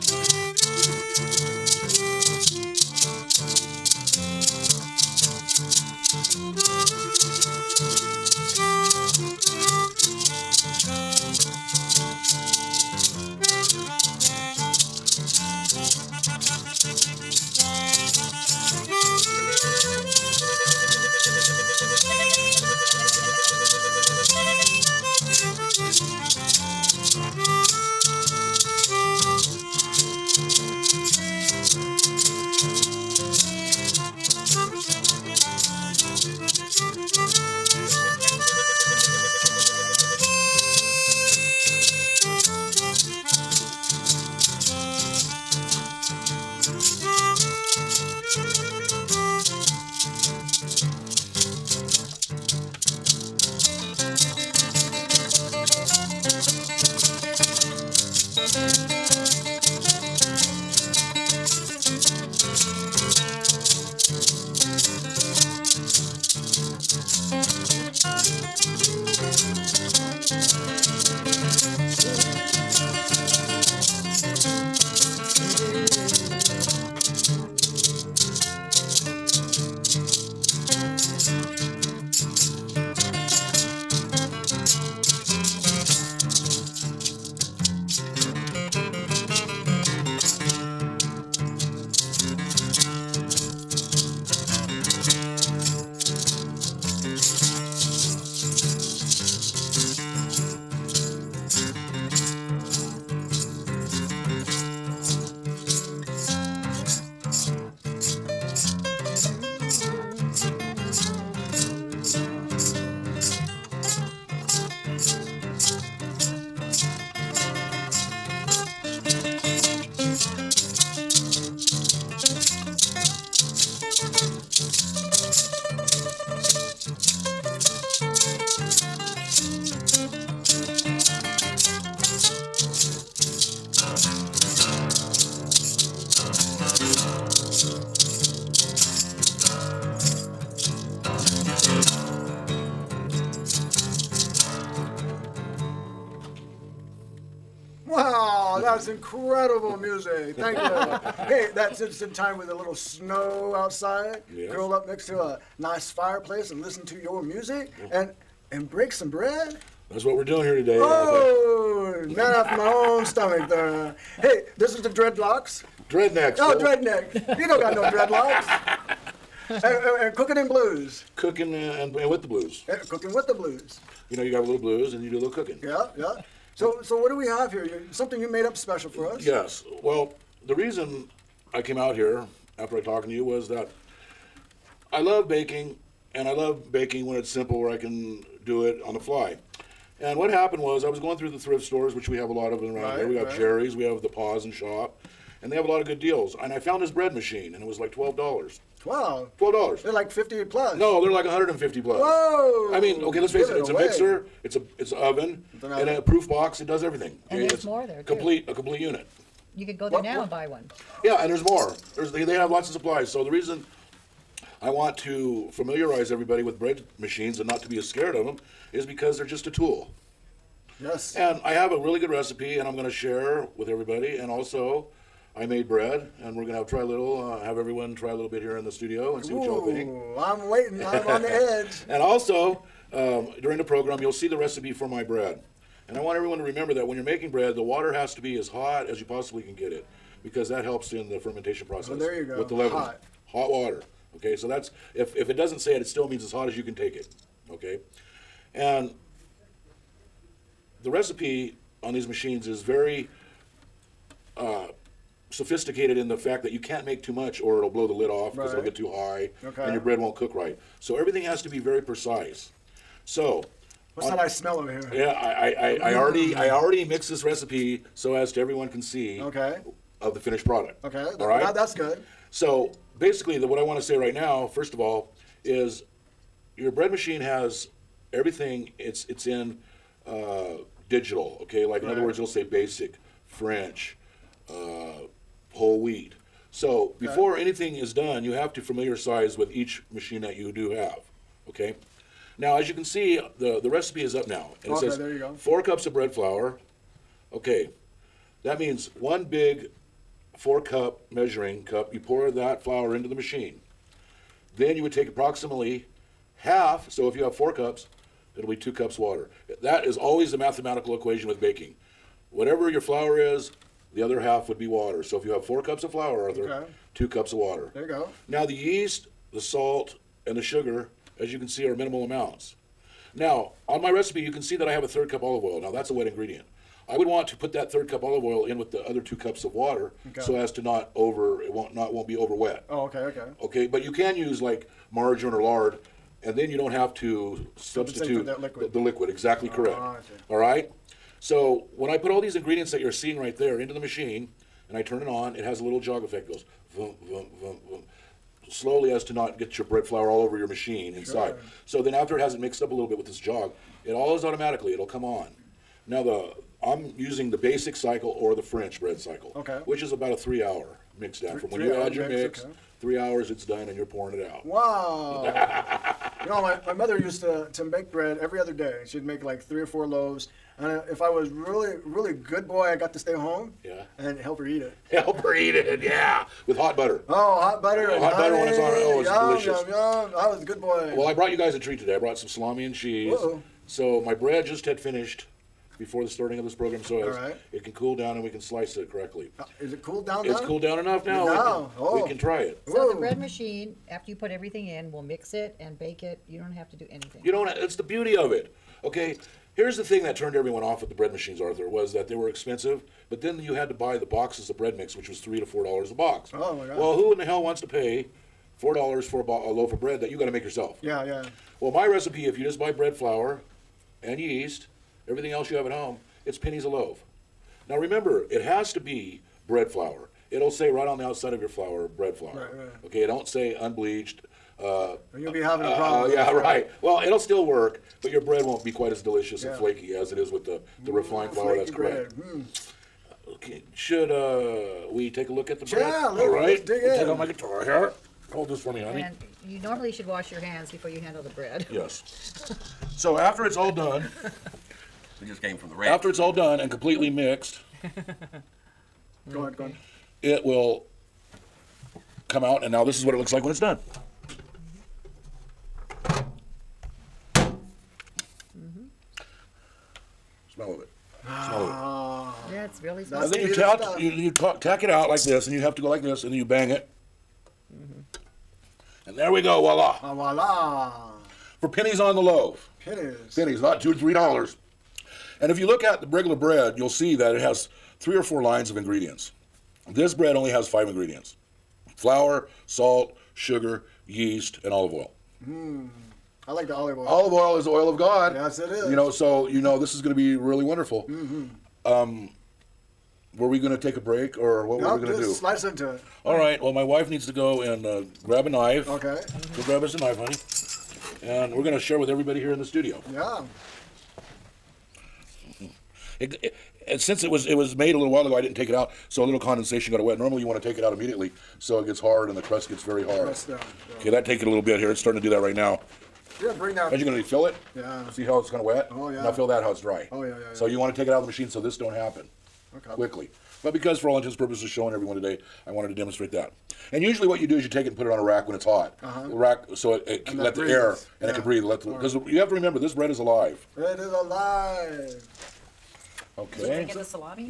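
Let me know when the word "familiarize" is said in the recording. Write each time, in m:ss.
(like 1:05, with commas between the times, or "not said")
3:35, 4:48.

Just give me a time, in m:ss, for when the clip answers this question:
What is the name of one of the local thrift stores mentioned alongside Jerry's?
3:14.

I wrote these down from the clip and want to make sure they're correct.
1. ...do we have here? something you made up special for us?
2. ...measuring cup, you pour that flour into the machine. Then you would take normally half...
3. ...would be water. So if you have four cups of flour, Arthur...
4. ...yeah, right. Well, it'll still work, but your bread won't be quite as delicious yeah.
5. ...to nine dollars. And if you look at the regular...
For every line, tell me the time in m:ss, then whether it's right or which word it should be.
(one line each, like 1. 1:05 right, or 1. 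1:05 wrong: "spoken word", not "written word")
1. 2:57 right
2. 5:01 wrong: "approximately", not "normally"
3. 5:14 right
4. 7:06 right
5. 7:53 wrong: "three", not "nine".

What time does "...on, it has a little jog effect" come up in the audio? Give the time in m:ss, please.
5:45.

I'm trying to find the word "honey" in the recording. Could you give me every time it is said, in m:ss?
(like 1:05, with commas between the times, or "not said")
6:18, 7:18, 8:20.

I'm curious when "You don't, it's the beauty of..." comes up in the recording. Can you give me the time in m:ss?
6:37.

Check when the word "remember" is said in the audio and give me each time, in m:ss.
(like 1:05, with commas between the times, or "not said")
3:56, 6:57, 8:52.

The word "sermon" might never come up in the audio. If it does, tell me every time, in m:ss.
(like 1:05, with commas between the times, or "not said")
not said.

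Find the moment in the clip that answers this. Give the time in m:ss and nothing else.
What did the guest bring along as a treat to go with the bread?
6:22.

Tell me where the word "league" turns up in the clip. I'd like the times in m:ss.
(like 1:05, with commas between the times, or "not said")
not said.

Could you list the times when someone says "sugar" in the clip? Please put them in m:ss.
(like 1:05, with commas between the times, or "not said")
5:20, 8:03.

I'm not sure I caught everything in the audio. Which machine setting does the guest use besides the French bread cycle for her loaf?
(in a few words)
basic cycle.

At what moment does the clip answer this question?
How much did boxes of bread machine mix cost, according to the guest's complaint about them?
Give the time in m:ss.
6:45.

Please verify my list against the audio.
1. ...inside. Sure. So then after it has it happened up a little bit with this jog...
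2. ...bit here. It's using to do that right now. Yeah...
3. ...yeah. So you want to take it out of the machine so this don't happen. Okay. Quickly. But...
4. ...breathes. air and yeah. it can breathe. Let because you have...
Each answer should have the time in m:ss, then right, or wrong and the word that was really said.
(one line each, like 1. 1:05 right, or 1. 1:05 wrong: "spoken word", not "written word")
1. 5:50 wrong: "mixed", not "happened"
2. 8:34 wrong: "starting", not "using"
3. 8:40 right
4. 8:50 right.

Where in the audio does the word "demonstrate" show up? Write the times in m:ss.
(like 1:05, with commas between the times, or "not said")
8:45.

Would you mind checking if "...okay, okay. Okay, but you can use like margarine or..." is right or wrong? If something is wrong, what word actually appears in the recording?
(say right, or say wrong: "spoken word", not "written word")
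right.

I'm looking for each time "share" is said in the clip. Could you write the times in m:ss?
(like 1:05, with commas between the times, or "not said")
3:42, 8:21.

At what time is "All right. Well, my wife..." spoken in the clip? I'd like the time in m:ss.
8:16.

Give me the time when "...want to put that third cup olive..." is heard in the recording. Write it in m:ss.
5:27.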